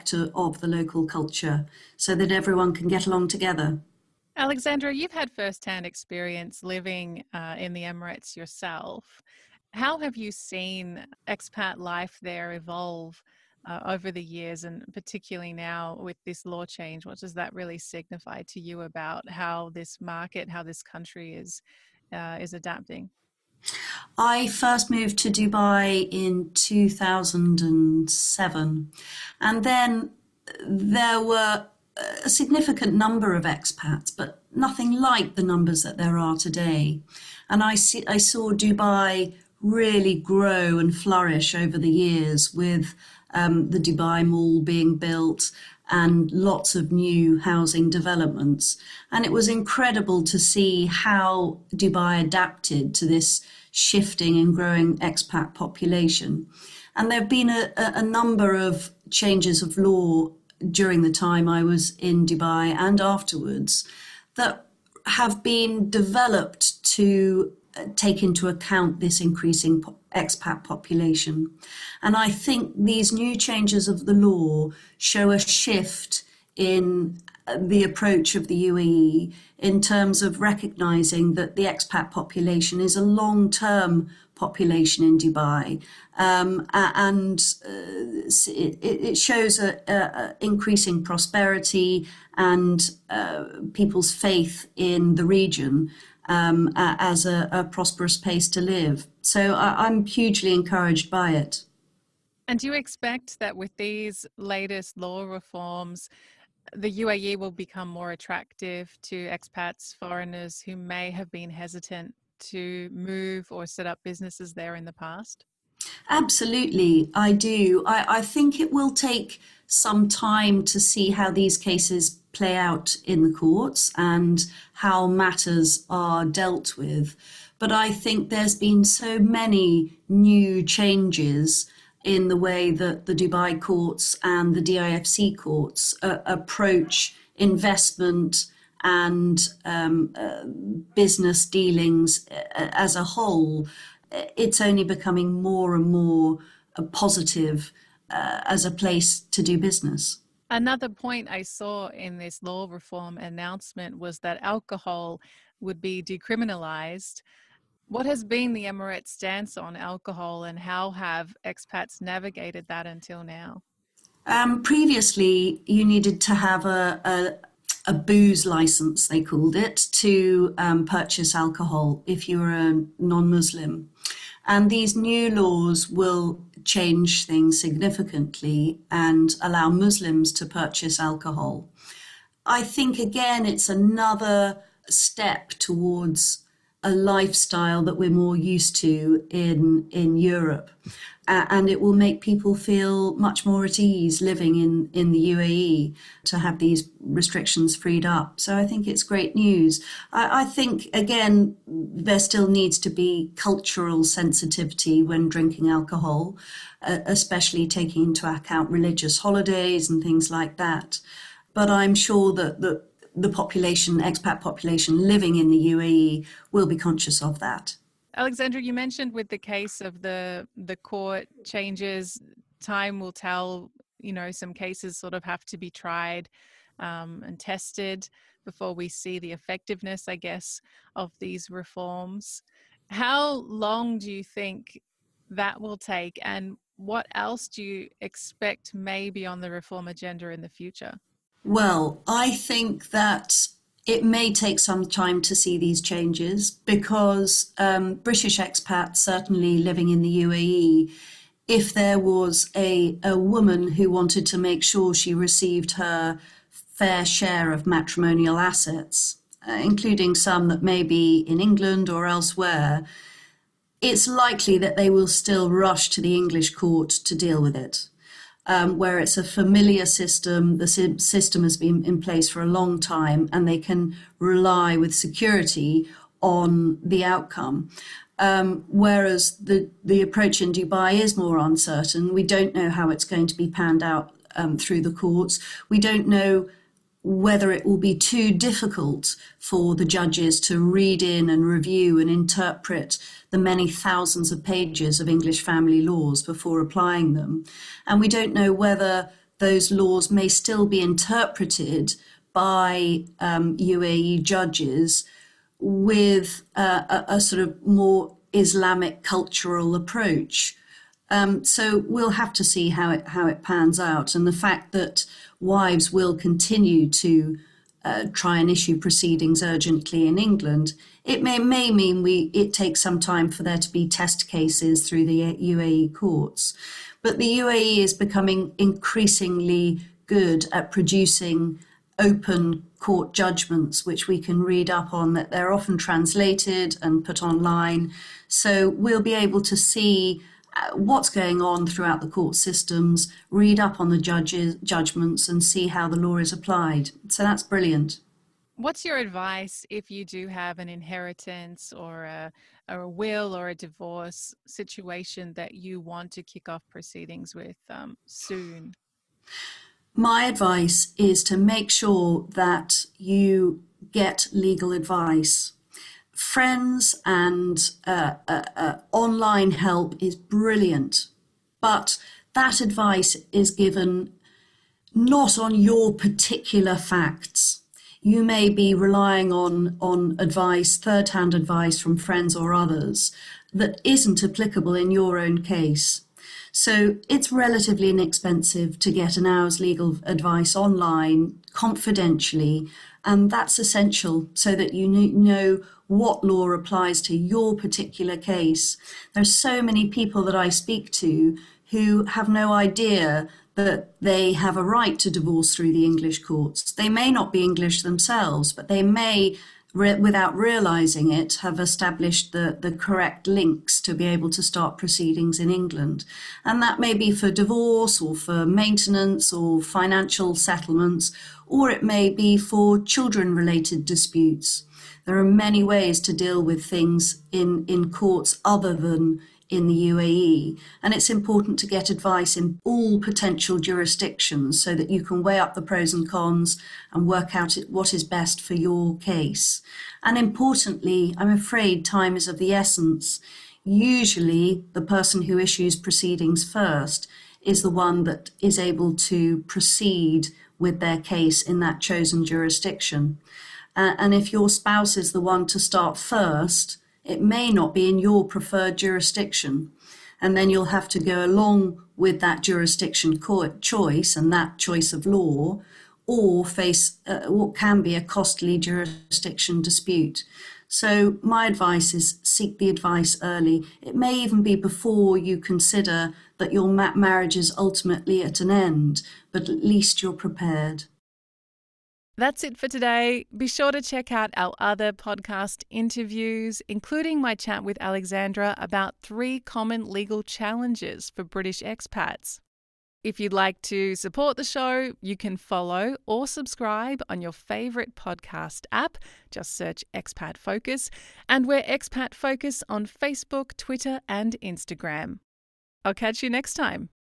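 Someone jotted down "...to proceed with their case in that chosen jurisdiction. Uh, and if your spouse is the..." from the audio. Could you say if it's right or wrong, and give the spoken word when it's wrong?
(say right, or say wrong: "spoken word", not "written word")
right.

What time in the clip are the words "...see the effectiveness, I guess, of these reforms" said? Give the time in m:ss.
3:48.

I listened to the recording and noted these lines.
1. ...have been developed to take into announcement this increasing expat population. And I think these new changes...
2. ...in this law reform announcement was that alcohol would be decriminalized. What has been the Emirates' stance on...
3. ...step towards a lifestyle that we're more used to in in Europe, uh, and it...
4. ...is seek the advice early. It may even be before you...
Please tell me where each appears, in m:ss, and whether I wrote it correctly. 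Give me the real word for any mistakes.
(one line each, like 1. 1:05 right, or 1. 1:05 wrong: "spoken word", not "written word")
1. 1:05 wrong: "account", not "announcement"
2. 2:31 right
3. 3:04 right
4. 7:51 right.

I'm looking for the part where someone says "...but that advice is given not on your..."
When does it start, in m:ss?
6:11.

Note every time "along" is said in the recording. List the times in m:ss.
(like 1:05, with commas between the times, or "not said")
0:03, 7:41.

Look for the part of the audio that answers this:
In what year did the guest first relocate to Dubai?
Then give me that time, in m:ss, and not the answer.
0:26.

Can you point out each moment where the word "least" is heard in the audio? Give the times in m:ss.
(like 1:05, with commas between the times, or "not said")
7:59.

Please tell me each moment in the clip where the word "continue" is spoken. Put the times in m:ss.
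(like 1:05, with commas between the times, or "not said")
5:16.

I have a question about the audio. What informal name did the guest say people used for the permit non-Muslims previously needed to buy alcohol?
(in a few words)
booze license.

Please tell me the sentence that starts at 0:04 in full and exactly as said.
Alexandra, you've had first-hand experience living uh, in the Emirates yourself.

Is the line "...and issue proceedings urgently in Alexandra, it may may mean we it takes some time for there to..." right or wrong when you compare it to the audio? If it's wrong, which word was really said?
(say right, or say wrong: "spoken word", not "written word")
wrong: "England", not "Alexandra".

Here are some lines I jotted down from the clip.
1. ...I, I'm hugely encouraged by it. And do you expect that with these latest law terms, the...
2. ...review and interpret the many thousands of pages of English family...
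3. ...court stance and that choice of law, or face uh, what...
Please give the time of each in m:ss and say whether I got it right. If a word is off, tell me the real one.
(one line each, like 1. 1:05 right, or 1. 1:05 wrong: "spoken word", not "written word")
1. 1:39 wrong: "reforms", not "terms"
2. 4:51 right
3. 7:43 wrong: "choice", not "stance".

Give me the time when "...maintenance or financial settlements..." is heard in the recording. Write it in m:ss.
6:58.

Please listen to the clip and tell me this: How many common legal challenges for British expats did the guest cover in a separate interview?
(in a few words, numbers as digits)
3.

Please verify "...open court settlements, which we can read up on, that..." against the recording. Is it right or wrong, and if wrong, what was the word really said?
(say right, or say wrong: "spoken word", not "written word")
wrong: "judgments", not "settlements".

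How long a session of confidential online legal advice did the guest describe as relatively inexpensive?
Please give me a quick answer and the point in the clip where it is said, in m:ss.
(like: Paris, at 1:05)
An hour, at 6:29.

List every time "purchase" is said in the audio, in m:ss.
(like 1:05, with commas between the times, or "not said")
2:50, 3:00.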